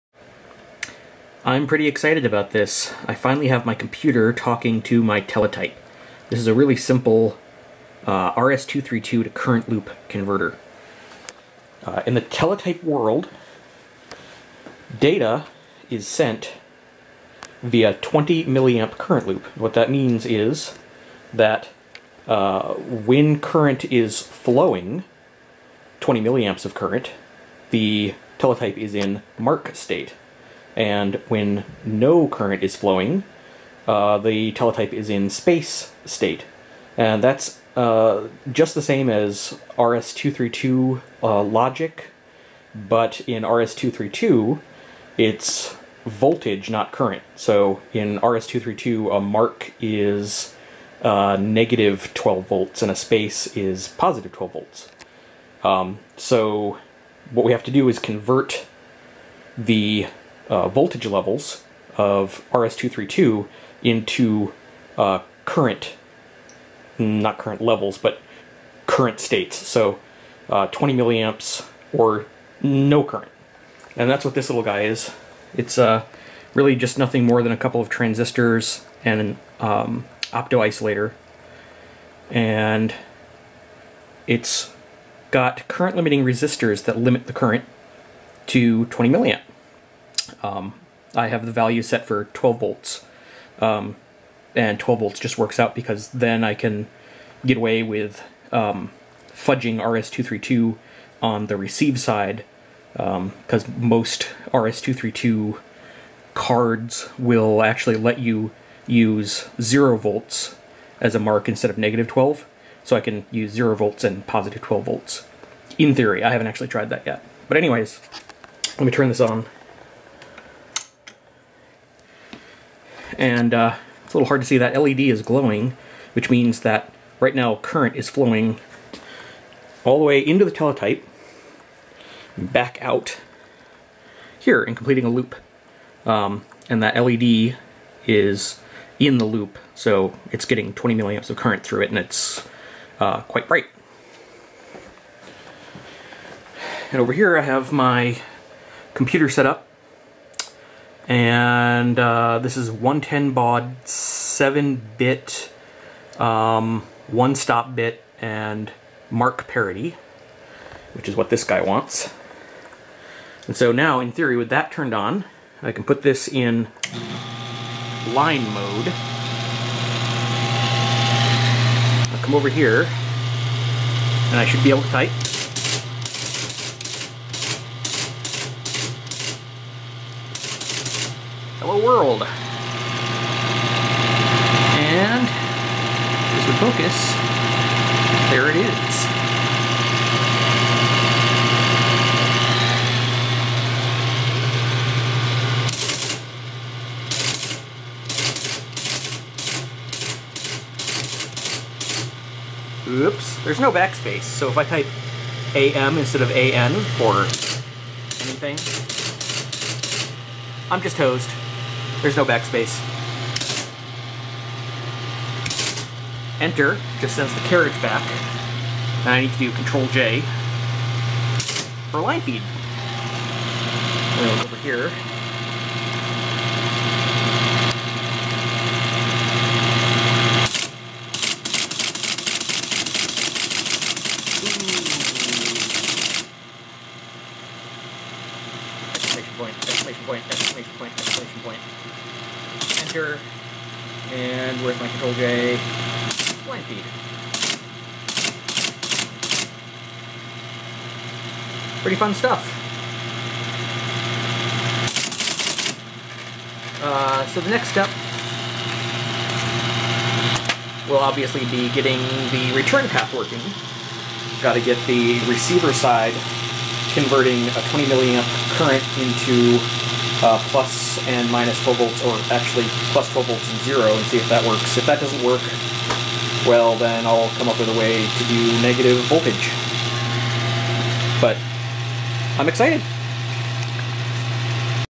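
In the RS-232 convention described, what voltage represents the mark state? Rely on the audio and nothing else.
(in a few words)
-12 volts.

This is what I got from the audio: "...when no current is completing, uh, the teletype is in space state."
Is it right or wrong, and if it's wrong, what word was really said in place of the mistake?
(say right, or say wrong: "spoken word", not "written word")
wrong: "flowing", not "completing".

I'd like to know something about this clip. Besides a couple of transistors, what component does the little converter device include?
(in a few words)
opto-isolator.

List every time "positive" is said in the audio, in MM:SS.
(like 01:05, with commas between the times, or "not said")
00:53, 01:54.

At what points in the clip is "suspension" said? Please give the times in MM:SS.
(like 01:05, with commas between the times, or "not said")
not said.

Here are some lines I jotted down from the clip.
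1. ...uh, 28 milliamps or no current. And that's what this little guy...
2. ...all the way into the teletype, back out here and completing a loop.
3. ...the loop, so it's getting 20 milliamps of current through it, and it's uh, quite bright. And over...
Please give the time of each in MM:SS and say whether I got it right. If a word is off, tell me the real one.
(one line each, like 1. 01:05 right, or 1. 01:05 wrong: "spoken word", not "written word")
1. 01:10 wrong: "20", not "28"
2. 02:09 right
3. 02:19 right.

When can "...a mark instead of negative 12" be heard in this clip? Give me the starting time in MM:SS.
01:51.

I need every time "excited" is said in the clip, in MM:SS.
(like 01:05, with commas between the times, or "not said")
00:01, 04:42.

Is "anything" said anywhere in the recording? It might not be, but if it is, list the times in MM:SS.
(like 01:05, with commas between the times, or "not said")
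03:28.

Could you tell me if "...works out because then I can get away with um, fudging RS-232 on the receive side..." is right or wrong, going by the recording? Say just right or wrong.
right.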